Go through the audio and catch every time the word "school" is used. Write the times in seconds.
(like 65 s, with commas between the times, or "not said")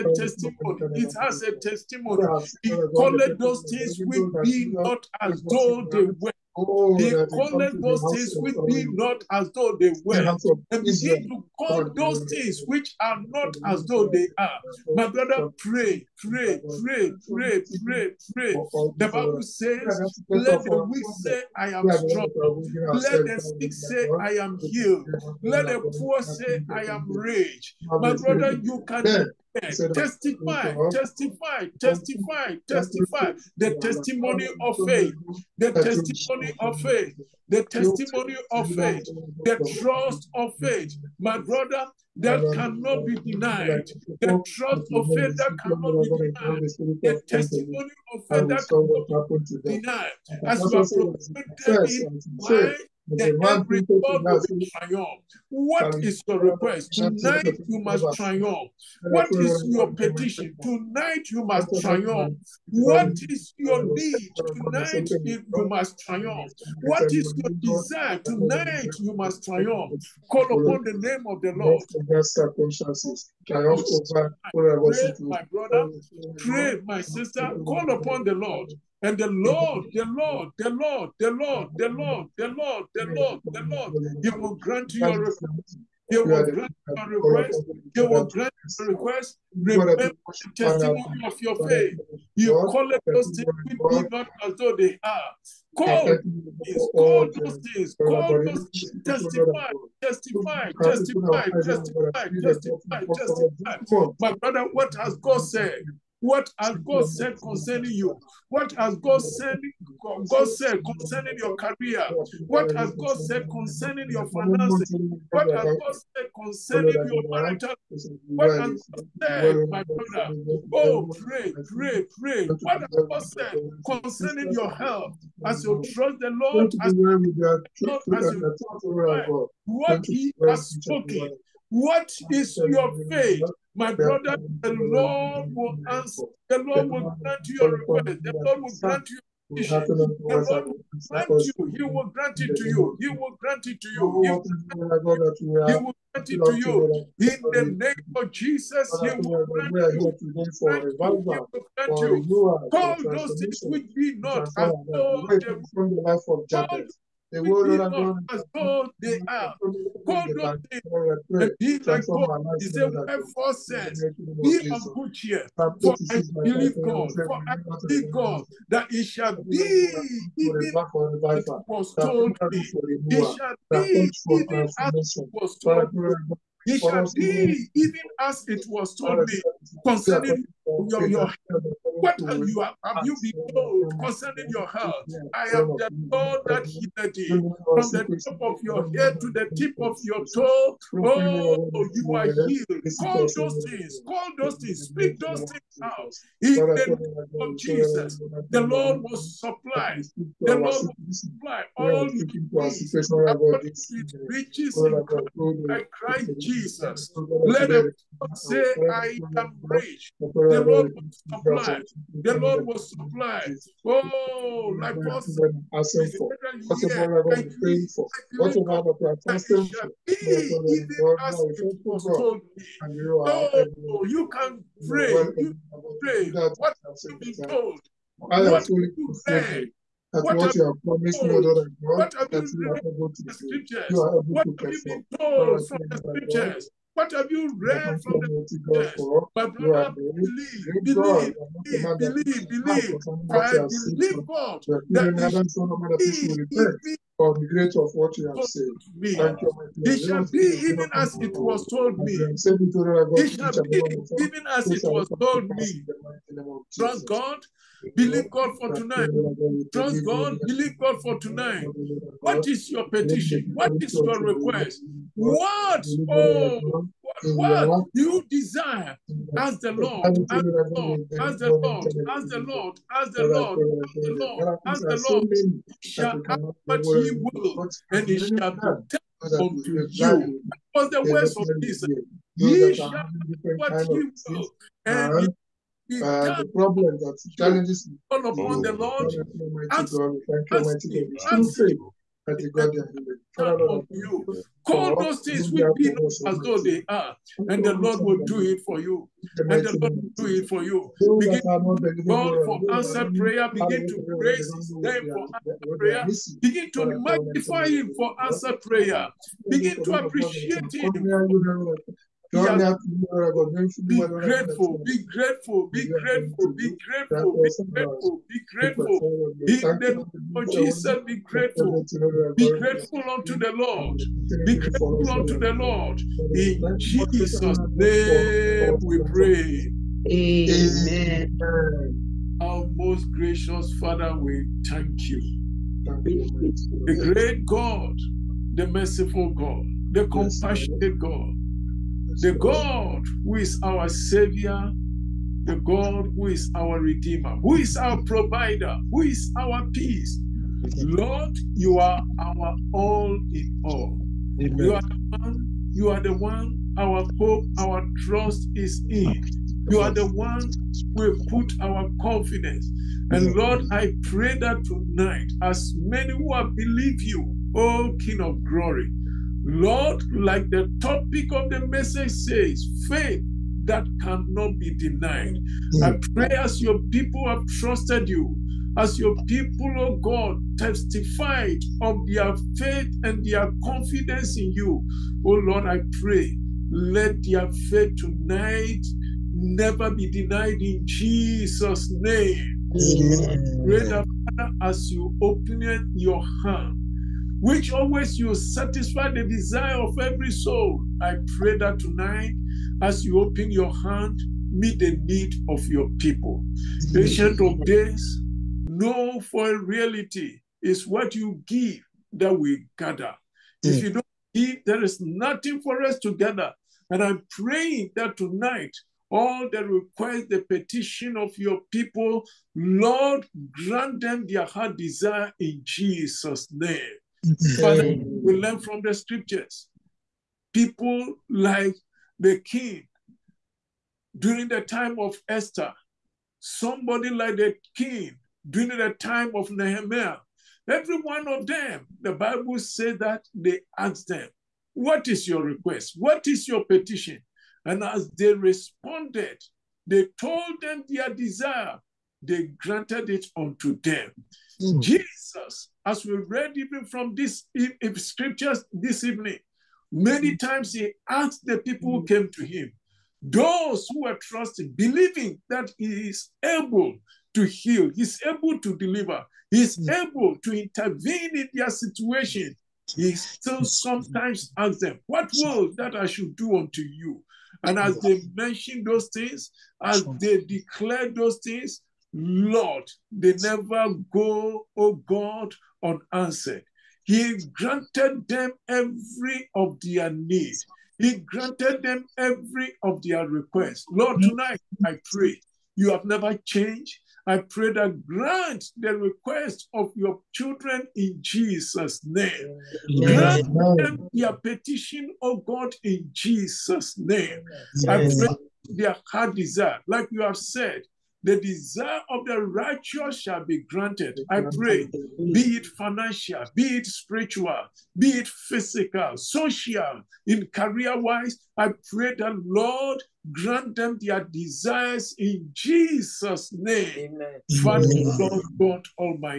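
not said.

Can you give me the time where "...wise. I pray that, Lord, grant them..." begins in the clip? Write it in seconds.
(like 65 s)
520 s.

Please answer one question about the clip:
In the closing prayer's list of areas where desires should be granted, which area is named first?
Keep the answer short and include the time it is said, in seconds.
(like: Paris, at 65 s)
Financial, at 515 s.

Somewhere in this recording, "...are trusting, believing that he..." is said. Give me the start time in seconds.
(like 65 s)
464 s.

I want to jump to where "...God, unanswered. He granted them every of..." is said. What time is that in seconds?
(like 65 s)
484 s.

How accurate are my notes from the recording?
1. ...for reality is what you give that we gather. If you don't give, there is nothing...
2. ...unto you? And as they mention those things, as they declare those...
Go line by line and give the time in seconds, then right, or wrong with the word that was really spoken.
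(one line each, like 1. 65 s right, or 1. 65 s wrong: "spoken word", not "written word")
1. 409 s right
2. 476 s right.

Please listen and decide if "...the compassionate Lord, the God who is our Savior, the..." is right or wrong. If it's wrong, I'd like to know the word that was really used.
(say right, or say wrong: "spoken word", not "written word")
wrong: "God", not "Lord".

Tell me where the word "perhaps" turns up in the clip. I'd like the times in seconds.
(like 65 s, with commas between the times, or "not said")
not said.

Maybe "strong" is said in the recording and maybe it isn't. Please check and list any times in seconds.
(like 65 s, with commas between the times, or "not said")
21 s.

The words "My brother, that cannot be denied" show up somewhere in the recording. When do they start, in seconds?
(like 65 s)
41 s.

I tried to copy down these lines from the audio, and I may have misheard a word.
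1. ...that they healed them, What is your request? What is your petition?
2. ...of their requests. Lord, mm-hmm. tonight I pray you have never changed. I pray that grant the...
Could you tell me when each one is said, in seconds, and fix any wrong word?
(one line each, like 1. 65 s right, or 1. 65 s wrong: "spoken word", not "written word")
1. 442 s wrong: "asked", not "healed"
2. 492 s right.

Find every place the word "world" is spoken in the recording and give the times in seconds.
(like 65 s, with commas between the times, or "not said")
157 s.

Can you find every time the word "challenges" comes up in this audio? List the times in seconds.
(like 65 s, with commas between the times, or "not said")
287 s.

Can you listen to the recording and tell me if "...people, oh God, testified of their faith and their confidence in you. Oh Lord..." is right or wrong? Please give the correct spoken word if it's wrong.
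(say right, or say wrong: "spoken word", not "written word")
right.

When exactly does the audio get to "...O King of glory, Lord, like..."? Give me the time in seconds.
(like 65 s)
367 s.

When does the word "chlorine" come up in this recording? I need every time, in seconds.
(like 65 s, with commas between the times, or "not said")
not said.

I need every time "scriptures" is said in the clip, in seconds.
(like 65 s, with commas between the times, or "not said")
235 s, 428 s, 457 s.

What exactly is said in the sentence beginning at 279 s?
That was the words of Jesus.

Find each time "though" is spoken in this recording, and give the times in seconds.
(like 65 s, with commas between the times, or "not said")
5 s, 9 s, 13 s, 94 s, 296 s.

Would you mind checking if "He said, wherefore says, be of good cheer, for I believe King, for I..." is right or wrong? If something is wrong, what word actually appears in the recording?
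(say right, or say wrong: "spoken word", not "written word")
wrong: "God", not "King".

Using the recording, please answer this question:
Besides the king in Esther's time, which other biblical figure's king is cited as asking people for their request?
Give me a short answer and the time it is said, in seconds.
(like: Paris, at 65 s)
Nehemiah, at 439 s.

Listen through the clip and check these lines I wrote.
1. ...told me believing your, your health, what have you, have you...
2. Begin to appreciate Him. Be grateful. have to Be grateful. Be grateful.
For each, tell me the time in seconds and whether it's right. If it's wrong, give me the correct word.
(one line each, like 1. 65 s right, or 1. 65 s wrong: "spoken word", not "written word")
1. 178 s wrong: "concerning", not "believing"
2. 309 s right.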